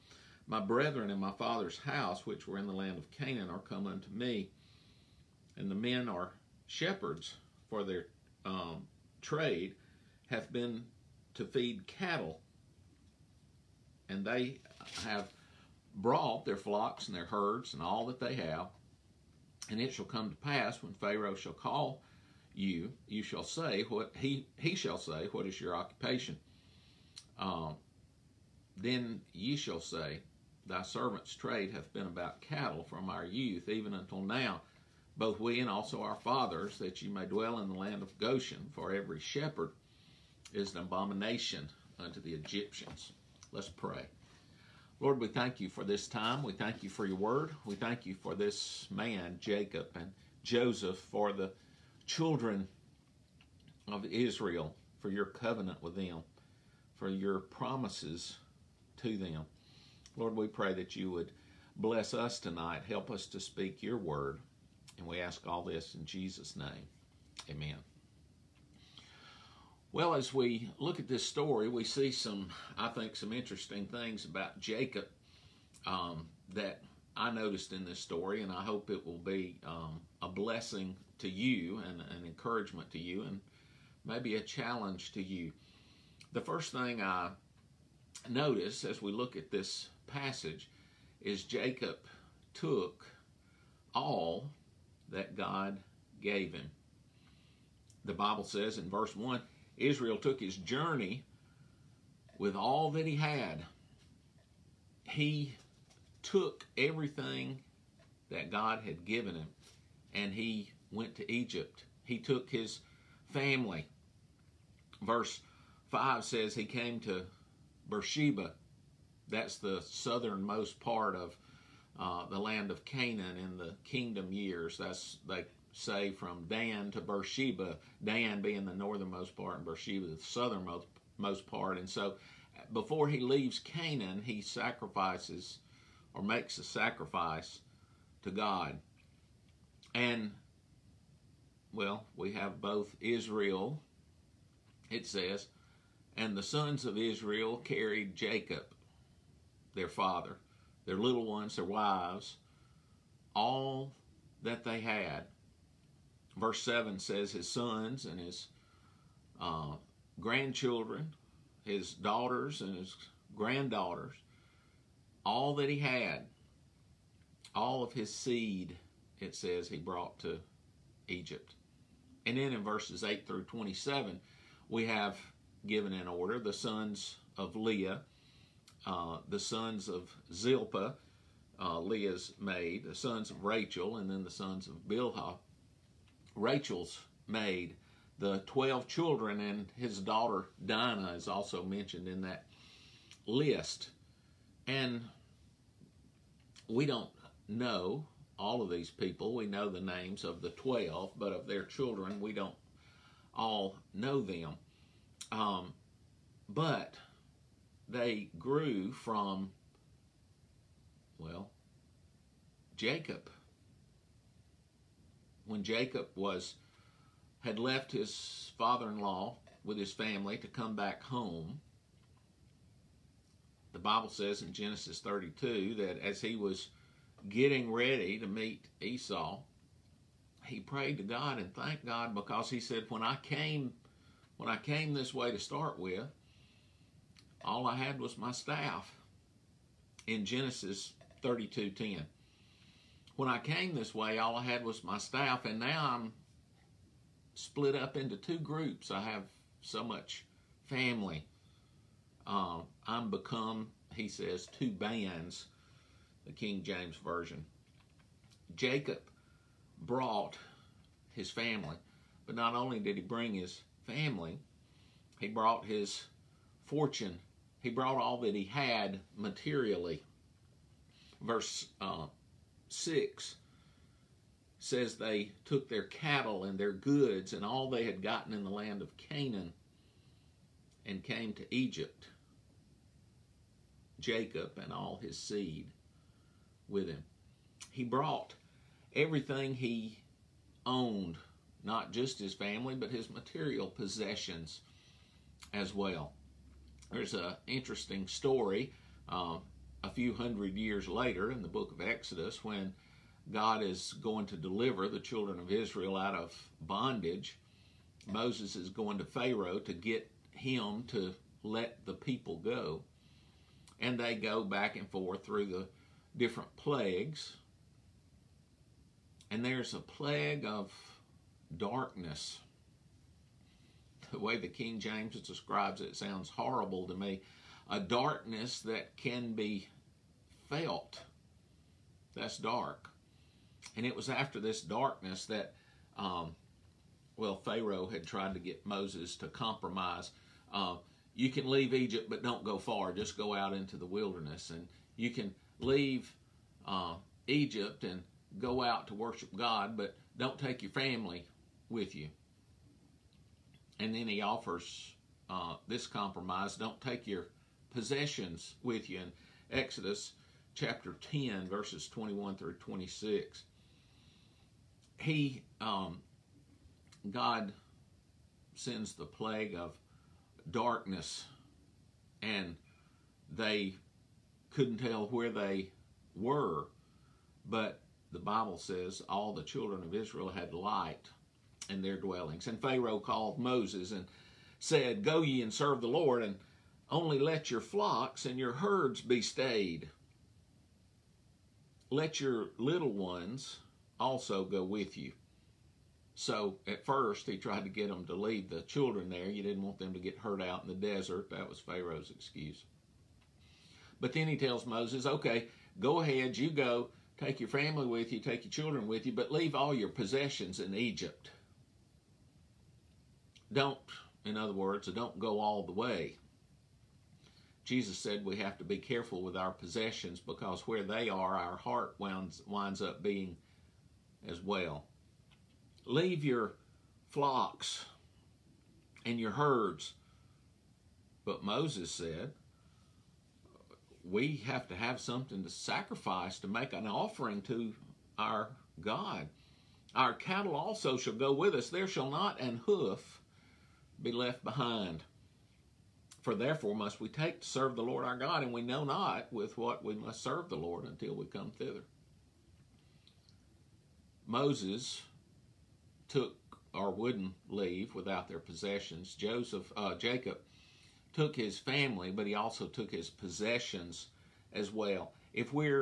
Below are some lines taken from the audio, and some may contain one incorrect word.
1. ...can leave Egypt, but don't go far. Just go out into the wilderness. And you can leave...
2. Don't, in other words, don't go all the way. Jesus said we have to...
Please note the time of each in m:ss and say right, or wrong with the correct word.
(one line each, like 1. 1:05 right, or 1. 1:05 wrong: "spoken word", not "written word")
1. 5:41 right
2. 6:53 right.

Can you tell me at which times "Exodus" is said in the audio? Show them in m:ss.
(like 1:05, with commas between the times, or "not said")
5:01, 5:59.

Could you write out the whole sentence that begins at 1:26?
The first thing I notice as we look at this passage is Jacob took all that God gave him.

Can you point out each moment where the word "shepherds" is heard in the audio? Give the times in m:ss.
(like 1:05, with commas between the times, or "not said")
0:06, 0:39.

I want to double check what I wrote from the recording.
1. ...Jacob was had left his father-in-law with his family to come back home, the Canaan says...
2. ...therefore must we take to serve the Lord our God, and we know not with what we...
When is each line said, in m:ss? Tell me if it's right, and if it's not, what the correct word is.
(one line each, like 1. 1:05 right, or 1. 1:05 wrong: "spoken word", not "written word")
1. 3:35 wrong: "Bible", not "Canaan"
2. 7:26 right.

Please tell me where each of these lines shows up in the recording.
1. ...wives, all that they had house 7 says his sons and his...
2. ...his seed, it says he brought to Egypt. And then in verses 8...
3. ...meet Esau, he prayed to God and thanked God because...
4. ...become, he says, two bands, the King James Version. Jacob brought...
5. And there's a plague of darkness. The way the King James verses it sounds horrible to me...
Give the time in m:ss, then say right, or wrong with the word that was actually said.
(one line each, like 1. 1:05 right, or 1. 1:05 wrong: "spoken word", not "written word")
1. 2:31 wrong: "verse", not "house"
2. 2:47 right
3. 3:48 right
4. 4:13 right
5. 5:19 wrong: "describes", not "verses".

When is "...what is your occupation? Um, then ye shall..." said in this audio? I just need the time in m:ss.
0:25.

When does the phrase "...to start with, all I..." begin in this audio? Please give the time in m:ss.
3:55.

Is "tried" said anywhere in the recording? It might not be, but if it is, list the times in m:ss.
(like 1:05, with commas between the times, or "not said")
5:38, 6:37.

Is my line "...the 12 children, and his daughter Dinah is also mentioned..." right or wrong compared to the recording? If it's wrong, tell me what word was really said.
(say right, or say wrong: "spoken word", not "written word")
right.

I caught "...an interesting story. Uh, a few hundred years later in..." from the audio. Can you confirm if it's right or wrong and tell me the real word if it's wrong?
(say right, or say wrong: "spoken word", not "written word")
right.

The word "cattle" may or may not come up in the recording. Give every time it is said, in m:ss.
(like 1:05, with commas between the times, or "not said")
0:11, 0:32, 4:35, 7:20.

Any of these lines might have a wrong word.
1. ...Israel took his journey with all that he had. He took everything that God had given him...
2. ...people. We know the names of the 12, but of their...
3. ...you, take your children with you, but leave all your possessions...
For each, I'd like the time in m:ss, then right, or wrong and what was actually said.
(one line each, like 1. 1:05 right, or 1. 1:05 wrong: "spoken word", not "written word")
1. 1:39 right
2. 3:18 right
3. 6:48 right.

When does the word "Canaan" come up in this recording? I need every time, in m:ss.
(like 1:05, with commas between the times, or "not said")
0:03, 2:02, 2:13, 4:38.